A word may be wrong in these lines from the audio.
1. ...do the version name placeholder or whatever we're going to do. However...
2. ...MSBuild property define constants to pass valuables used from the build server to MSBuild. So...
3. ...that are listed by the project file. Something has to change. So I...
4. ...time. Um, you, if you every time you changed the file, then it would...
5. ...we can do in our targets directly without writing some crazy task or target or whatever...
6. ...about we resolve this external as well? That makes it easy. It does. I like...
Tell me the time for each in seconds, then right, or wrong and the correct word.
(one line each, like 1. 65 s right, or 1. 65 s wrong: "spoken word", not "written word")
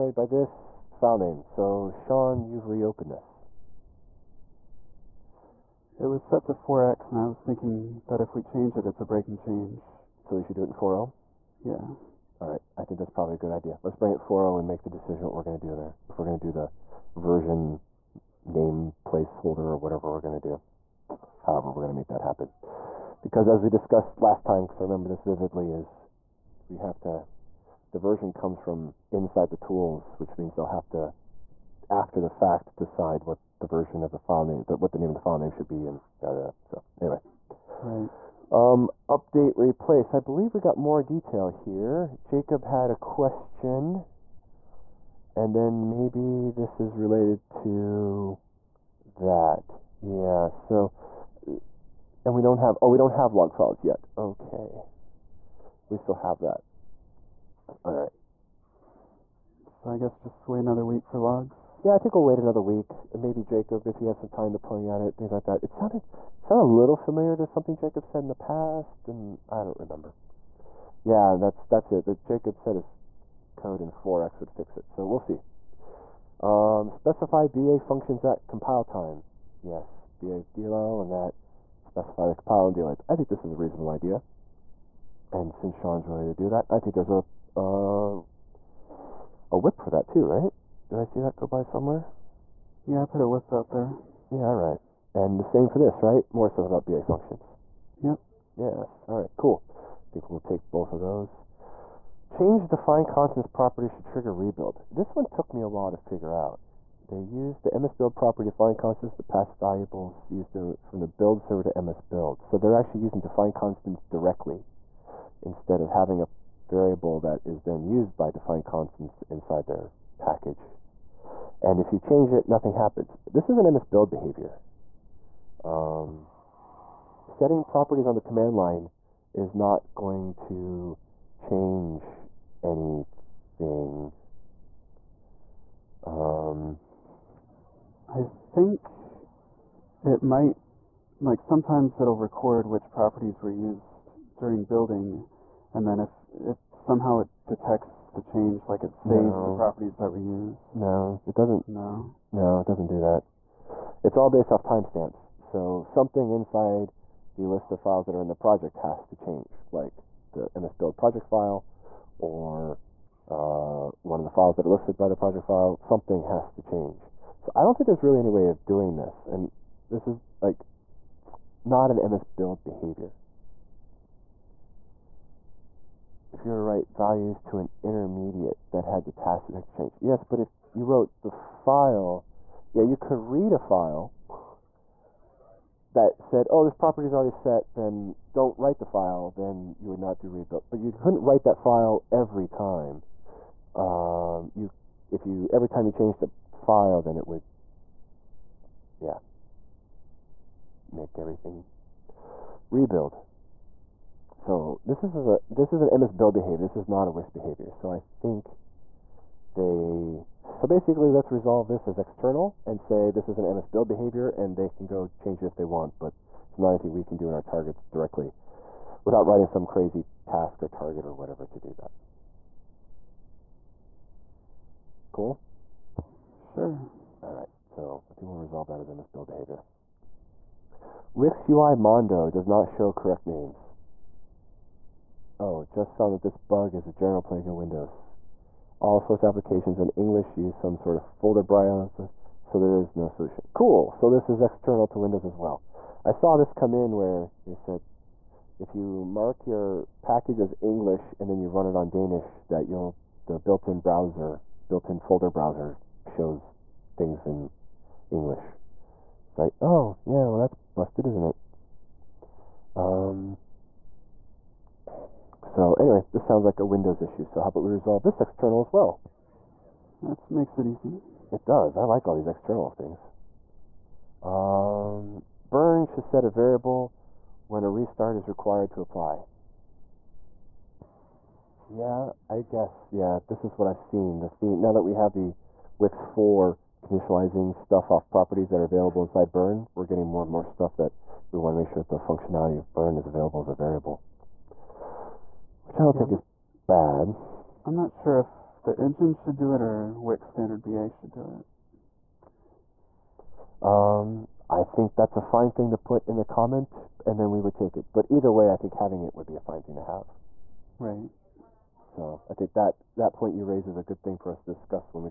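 1. 16 s right
2. 107 s right
3. 164 s right
4. 192 s right
5. 216 s right
6. 267 s right.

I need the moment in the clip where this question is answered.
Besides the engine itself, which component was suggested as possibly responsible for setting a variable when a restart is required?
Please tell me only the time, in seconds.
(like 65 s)
299 s.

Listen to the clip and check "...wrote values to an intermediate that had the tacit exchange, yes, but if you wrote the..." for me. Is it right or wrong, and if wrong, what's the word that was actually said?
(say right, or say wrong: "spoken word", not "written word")
wrong: "write", not "wrote".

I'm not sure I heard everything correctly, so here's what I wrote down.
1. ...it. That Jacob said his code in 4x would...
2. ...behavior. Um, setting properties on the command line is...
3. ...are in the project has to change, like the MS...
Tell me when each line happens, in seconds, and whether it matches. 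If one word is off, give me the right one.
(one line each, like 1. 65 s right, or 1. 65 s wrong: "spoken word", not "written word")
1. 71 s right
2. 124 s right
3. 158 s right.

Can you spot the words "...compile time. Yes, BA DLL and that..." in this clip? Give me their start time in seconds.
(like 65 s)
78 s.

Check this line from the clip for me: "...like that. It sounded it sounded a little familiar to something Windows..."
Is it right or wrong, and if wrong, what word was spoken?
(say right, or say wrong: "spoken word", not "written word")
wrong: "Jacob", not "Windows".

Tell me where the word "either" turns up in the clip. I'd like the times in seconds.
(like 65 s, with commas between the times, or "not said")
308 s.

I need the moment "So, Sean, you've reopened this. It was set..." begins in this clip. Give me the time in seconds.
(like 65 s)
1 s.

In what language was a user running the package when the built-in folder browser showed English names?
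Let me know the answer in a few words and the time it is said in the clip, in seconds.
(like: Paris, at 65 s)
Danish, at 251 s.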